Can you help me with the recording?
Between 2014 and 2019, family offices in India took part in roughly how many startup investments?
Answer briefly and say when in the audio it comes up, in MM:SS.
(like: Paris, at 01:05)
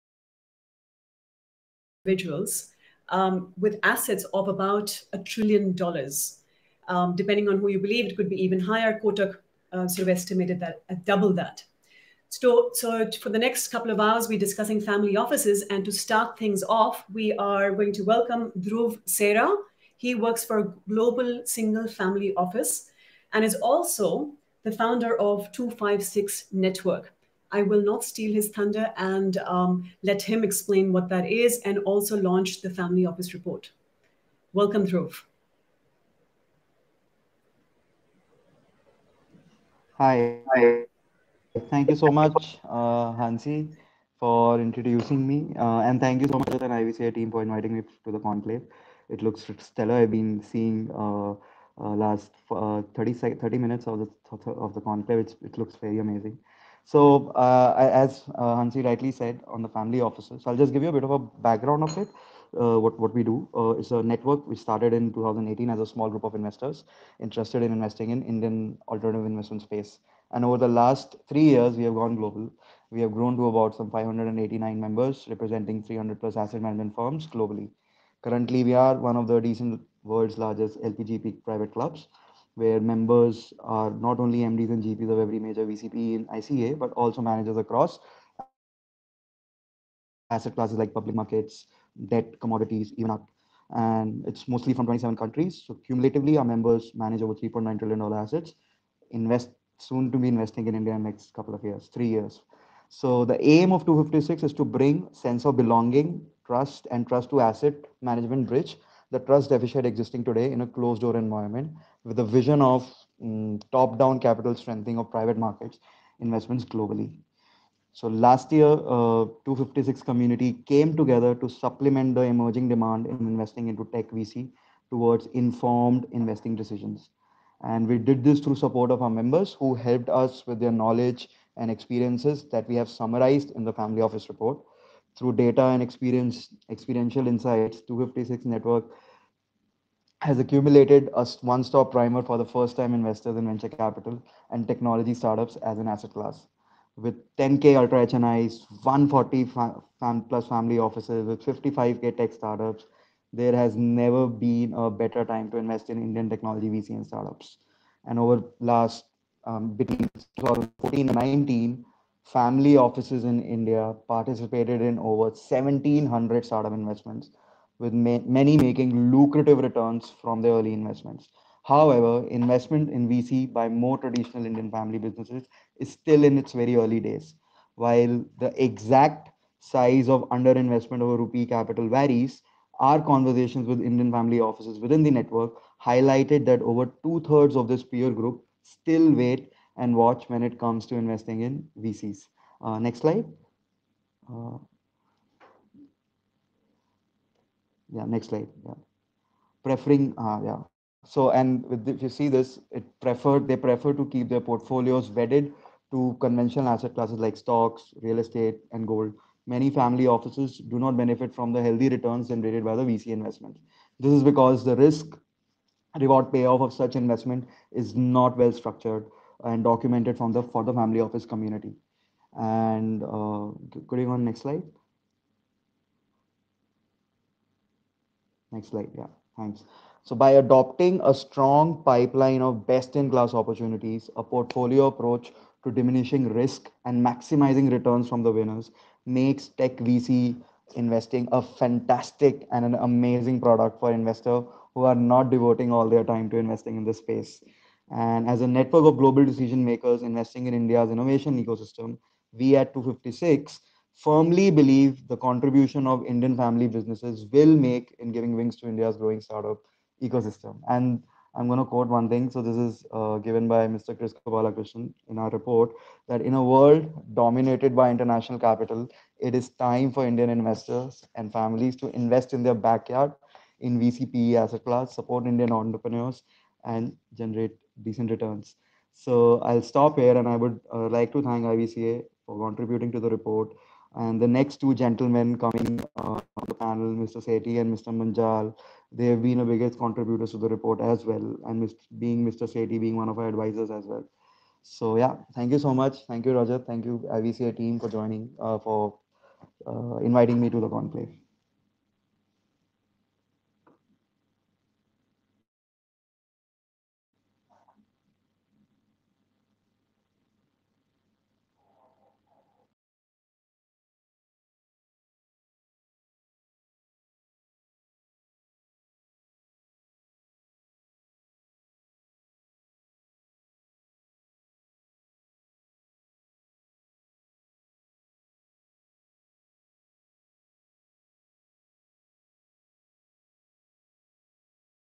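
1,700, at 02:45.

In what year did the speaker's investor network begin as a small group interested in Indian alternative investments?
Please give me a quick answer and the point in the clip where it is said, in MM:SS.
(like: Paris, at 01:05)
2018, at 01:05.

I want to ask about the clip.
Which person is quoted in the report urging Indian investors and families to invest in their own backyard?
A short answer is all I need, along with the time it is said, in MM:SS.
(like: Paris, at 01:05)
Kris Gopalakrishnan, at 04:23.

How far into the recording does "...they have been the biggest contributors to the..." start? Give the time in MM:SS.
04:48.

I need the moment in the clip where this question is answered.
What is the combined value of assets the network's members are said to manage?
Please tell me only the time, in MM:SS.
01:37.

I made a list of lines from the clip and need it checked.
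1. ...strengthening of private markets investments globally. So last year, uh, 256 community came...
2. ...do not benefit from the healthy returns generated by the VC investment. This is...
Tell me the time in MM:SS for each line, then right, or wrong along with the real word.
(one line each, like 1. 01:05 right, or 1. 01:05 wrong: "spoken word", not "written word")
1. 01:54 right
2. 03:30 right.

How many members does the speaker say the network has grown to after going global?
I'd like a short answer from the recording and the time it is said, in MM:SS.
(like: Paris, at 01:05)
589, at 01:13.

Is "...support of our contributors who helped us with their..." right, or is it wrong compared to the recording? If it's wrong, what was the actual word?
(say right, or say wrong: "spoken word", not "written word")
wrong: "members", not "contributors".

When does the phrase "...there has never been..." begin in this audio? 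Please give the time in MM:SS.
02:33.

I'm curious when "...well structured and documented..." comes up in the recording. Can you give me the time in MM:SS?
03:38.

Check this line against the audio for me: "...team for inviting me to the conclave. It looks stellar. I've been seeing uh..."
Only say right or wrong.
right.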